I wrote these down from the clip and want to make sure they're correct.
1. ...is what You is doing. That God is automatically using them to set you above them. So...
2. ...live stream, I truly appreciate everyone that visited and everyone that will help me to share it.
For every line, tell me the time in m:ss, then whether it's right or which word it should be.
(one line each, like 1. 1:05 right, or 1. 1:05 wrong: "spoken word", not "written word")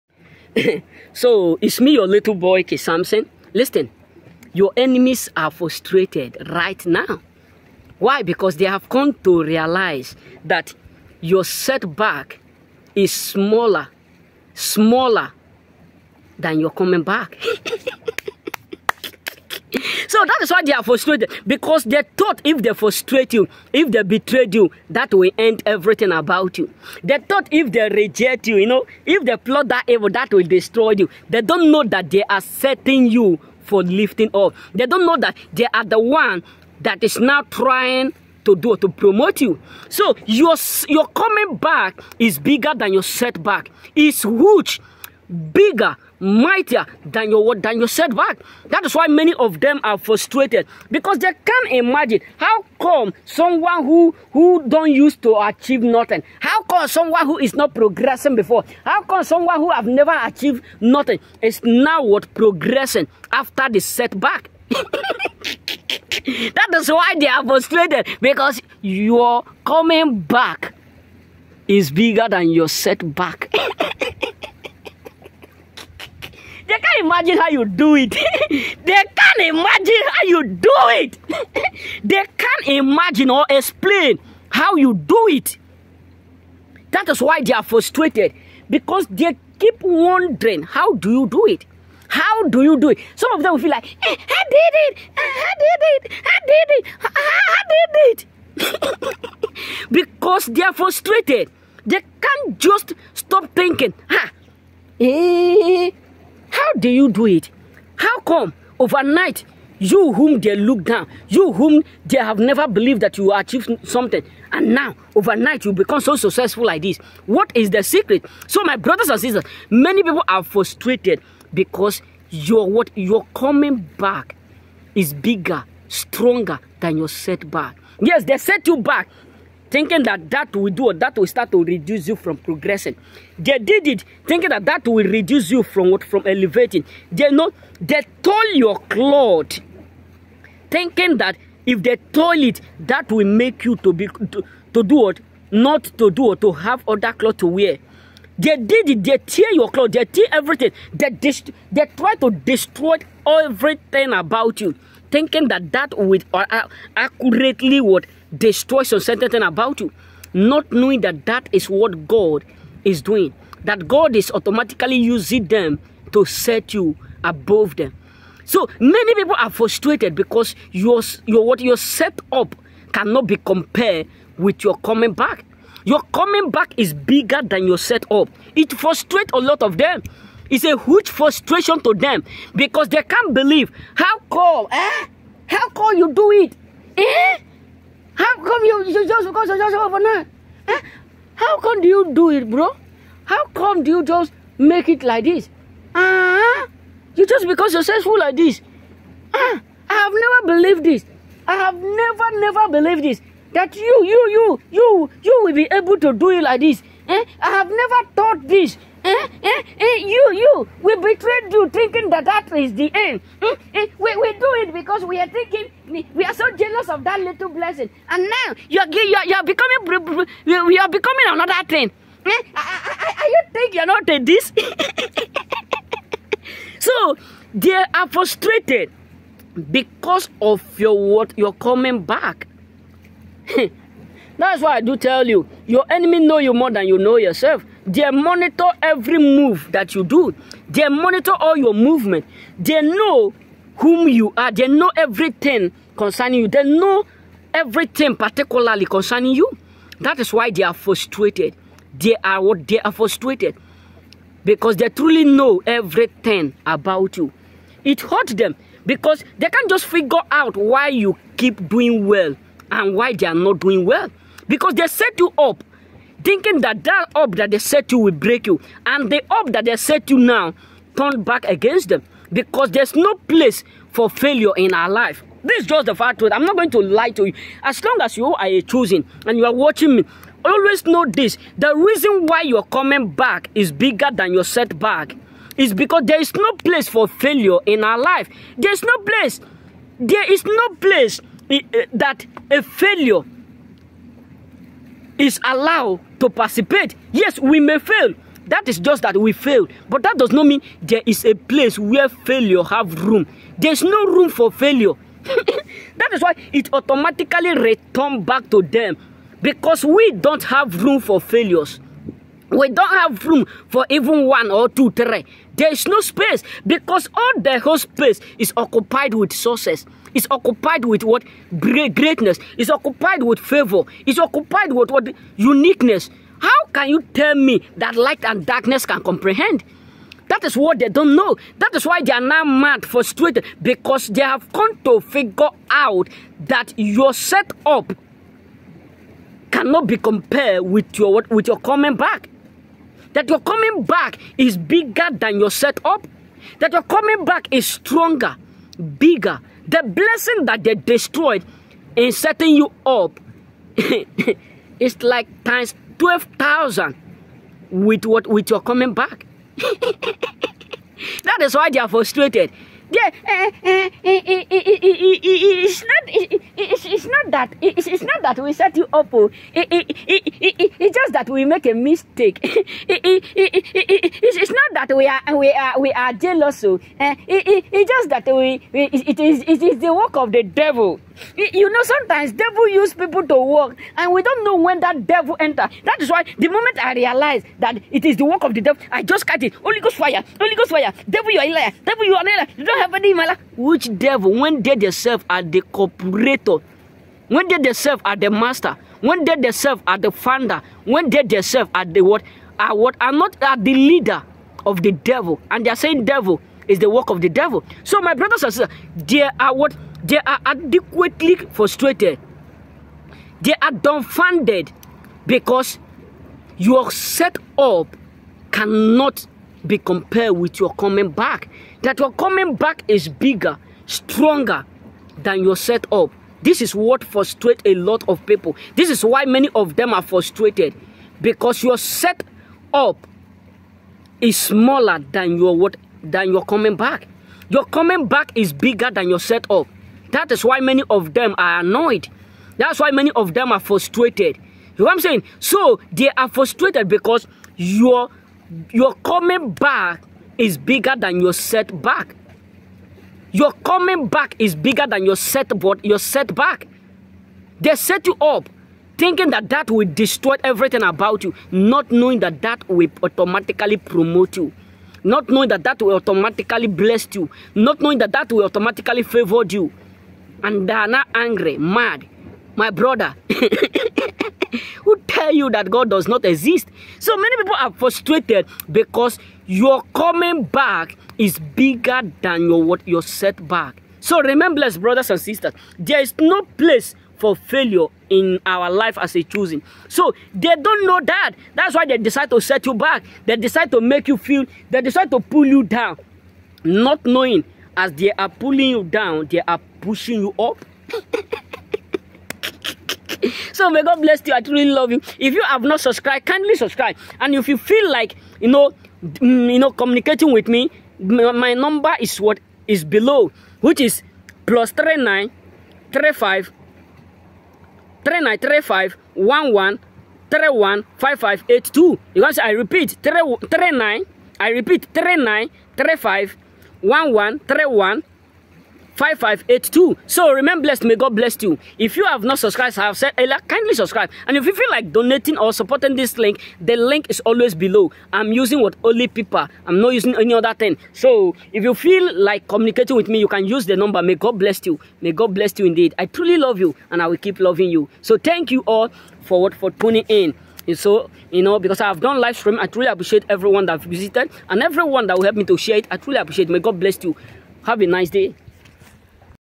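1. 2:41 wrong: "God", not "You"
2. 9:12 right.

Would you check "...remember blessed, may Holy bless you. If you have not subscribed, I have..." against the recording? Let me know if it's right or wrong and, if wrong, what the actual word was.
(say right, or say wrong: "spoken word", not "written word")
wrong: "God", not "Holy".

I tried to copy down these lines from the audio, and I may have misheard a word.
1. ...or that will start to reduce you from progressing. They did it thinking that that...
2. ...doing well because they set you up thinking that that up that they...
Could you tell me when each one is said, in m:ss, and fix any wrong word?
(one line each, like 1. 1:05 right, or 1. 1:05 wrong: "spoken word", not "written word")
1. 2:10 right
2. 4:23 right.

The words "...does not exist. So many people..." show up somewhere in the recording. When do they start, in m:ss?
7:55.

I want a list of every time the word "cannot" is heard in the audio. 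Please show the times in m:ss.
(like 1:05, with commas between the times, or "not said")
2:52, 5:39, 6:58.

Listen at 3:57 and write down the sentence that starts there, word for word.
They monitor every move that you do.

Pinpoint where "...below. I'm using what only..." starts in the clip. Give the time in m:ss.
8:57.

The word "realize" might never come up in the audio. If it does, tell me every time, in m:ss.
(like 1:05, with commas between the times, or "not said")
0:09, 6:26.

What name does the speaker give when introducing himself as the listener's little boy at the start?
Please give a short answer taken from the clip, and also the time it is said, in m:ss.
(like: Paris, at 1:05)
K. Samson, at 0:02.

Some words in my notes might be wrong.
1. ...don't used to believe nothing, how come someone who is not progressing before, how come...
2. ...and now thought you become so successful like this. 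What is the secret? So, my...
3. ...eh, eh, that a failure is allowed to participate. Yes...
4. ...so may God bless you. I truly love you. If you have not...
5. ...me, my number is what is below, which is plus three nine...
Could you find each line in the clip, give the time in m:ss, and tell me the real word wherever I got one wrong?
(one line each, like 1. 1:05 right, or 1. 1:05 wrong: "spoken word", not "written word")
1. 0:54 wrong: "achieve", not "believe"
2. 1:54 wrong: "overnight", not "thought"
3. 4:51 right
4. 8:23 right
5. 8:30 right.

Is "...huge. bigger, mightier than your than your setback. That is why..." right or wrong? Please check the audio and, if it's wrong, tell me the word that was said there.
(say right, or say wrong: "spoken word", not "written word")
right.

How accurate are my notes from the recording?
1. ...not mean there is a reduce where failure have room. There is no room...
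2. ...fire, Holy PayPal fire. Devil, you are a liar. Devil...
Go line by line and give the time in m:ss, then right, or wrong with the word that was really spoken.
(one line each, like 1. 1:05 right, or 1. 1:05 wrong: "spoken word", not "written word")
1. 5:00 wrong: "place", not "reduce"
2. 6:29 wrong: "Ghost", not "PayPal".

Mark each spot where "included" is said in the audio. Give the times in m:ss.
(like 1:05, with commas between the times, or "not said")
not said.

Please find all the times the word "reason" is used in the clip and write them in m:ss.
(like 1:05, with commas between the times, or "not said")
4:41.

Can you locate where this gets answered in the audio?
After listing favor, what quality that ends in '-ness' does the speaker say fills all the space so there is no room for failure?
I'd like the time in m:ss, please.
5:25.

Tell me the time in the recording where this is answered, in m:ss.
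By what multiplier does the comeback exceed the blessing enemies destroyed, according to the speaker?
5:56.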